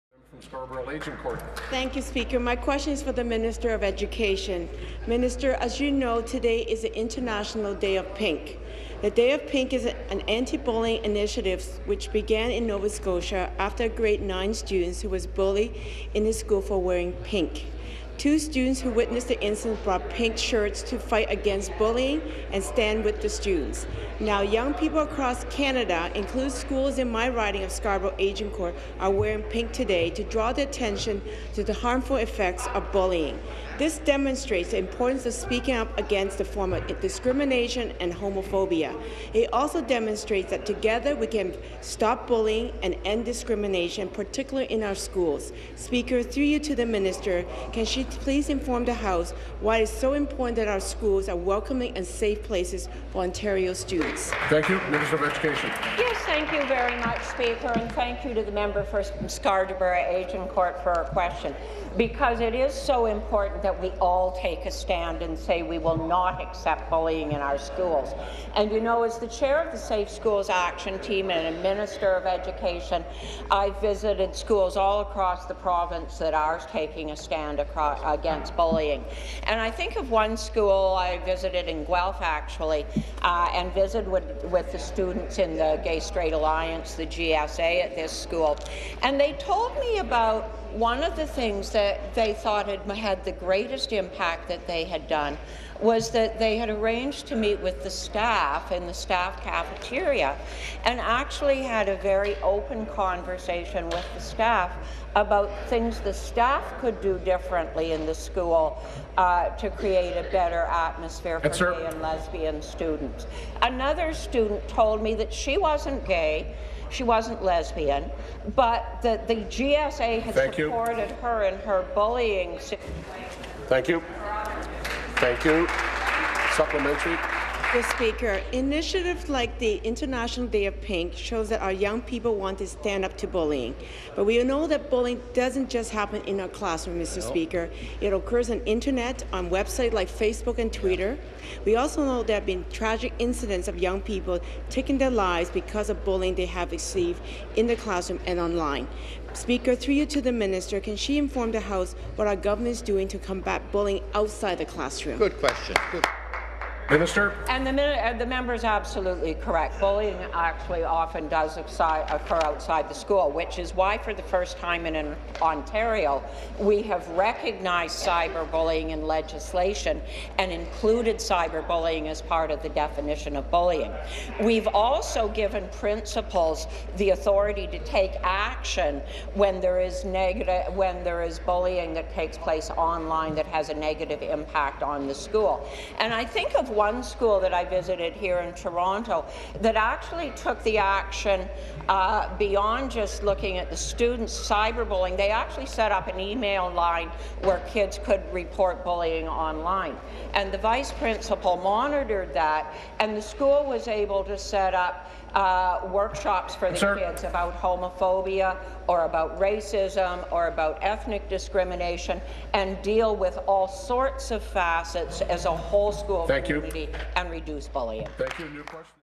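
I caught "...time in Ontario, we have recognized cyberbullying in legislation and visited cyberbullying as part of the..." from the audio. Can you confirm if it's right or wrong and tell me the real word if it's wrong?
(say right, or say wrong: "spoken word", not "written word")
wrong: "included", not "visited".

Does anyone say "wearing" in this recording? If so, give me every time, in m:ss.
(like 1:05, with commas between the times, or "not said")
0:16, 0:29.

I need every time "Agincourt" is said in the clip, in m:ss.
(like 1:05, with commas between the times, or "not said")
0:00, 0:28, 0:59.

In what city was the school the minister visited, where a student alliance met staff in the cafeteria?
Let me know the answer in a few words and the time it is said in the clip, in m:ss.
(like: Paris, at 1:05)
Guelph, at 1:21.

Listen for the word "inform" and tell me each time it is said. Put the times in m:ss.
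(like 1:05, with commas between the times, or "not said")
0:48, 2:31.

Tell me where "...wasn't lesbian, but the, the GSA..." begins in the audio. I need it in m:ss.
1:57.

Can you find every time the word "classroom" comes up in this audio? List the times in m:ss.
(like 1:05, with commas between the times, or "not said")
2:16, 2:27, 2:34.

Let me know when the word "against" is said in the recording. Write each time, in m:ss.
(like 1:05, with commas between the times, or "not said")
0:21, 0:35, 1:18.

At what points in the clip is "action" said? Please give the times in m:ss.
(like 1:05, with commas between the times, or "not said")
1:10, 2:58, 3:10.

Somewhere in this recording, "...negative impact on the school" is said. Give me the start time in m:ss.
3:03.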